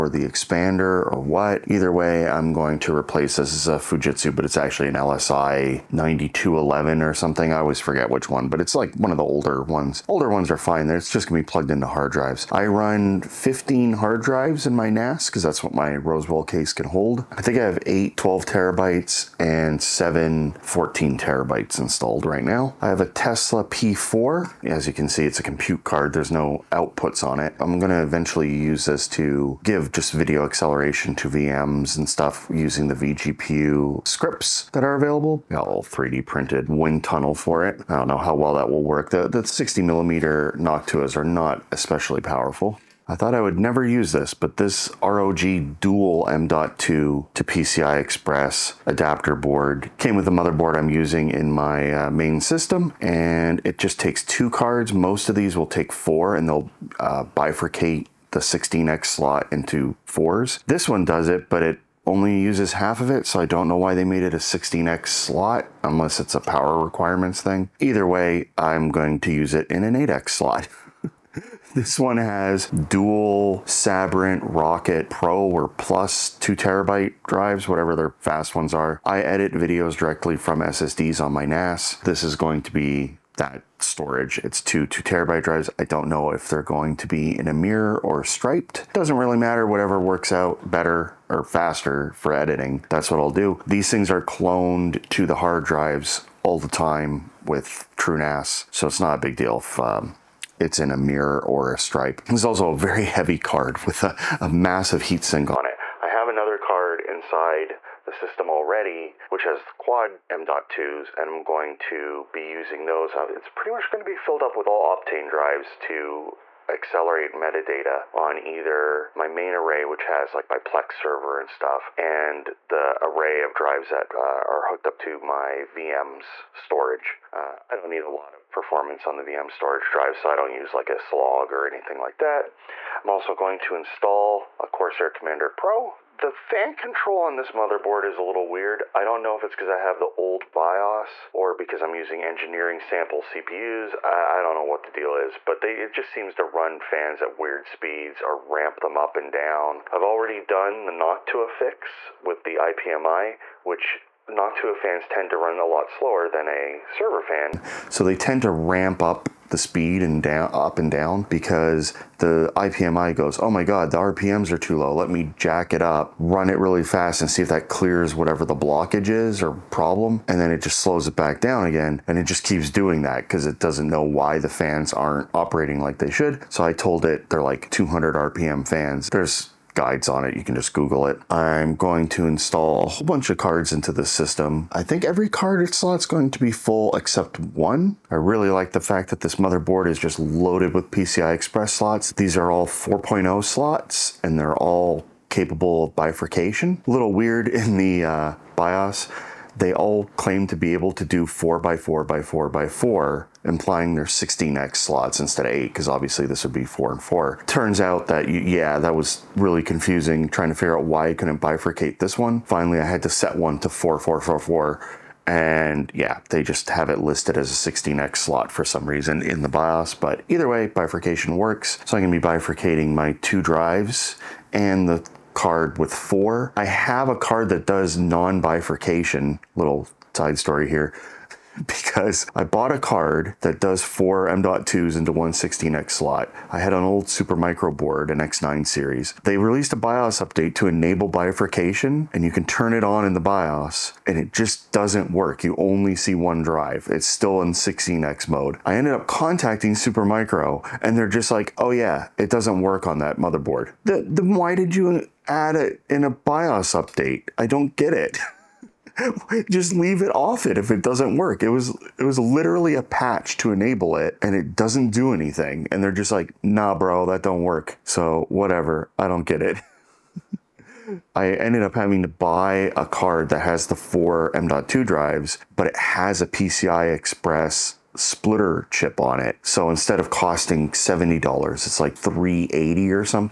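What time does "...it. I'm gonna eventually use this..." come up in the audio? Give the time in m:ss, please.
0:27.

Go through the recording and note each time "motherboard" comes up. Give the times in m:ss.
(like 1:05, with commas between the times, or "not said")
0:50, 2:17, 3:09, 4:13.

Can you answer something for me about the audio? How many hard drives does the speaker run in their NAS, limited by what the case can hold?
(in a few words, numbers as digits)
15.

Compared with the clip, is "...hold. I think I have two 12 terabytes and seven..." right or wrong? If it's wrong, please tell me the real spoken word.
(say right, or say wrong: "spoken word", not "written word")
wrong: "eight", not "two".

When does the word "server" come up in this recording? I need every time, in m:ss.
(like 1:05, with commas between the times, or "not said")
2:00, 2:36.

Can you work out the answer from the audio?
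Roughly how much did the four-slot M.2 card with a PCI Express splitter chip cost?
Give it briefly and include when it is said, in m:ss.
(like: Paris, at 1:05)
$380, at 4:41.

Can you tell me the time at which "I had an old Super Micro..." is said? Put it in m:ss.
3:56.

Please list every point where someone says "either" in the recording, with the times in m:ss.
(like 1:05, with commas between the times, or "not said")
0:01, 1:07, 1:58, 3:40.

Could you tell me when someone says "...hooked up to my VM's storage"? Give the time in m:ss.
2:04.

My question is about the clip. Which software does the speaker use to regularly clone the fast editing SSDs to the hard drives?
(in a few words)
TrueNAS.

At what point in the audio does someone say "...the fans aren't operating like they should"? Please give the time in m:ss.
2:54.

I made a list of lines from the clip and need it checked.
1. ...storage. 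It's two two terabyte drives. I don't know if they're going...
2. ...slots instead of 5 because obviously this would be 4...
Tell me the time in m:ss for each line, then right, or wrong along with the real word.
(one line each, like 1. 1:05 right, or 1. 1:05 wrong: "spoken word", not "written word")
1. 1:23 right
2. 3:24 wrong: "8", not "5".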